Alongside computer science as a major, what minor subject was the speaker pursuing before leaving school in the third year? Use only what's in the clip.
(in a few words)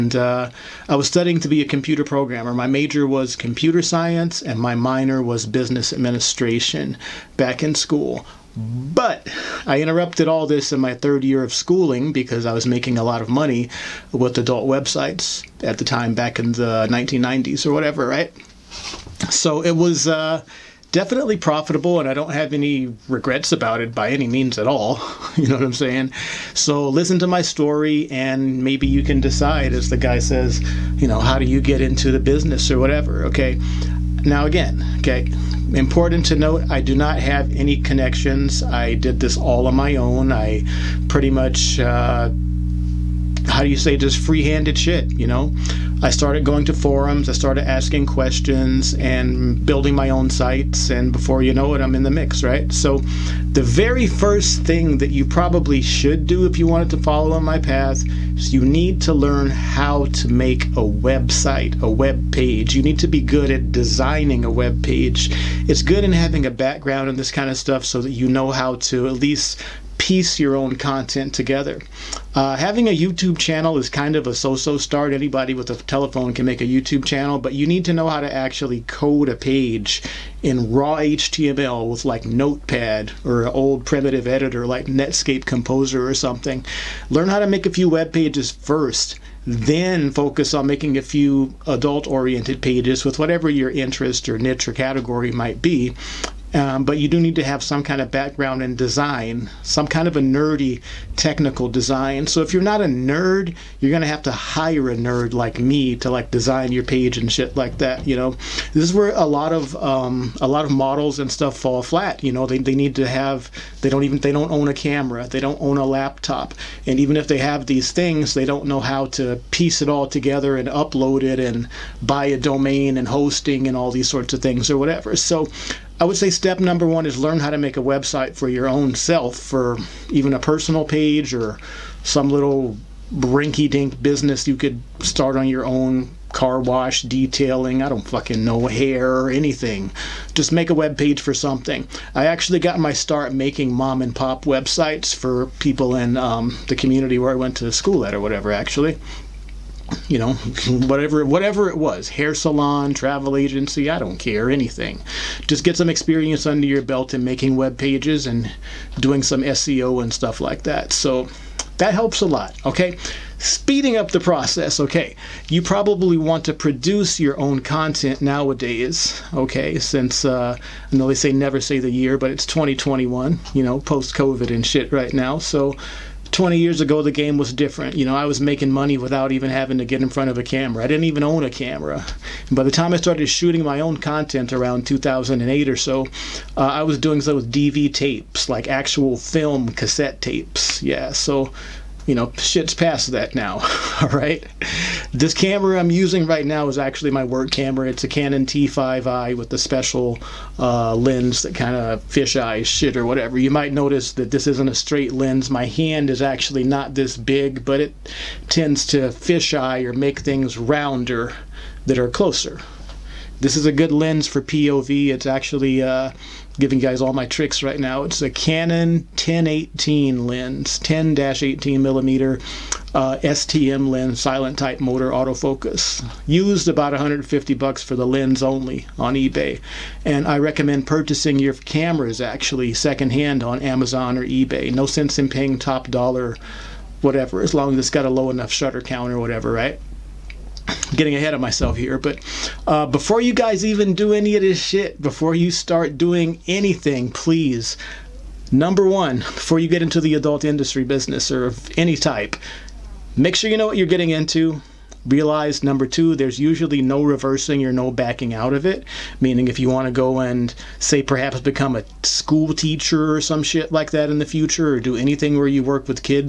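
business administration.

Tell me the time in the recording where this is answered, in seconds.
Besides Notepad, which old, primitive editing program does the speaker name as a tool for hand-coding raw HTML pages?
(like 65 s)
84 s.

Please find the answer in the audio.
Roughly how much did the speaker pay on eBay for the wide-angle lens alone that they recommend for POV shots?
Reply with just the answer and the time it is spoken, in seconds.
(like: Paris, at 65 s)
$150, at 226 s.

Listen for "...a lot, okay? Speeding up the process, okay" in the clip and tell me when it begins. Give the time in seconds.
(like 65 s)
162 s.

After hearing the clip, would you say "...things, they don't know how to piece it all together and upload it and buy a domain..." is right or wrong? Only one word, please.
right.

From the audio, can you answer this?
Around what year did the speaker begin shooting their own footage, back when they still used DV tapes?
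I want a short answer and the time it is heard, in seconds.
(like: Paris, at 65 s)
2008, at 184 s.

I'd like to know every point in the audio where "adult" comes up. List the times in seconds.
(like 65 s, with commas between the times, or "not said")
14 s, 91 s, 250 s.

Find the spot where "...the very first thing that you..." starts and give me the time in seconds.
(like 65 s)
53 s.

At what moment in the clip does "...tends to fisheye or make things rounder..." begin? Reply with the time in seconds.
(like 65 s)
208 s.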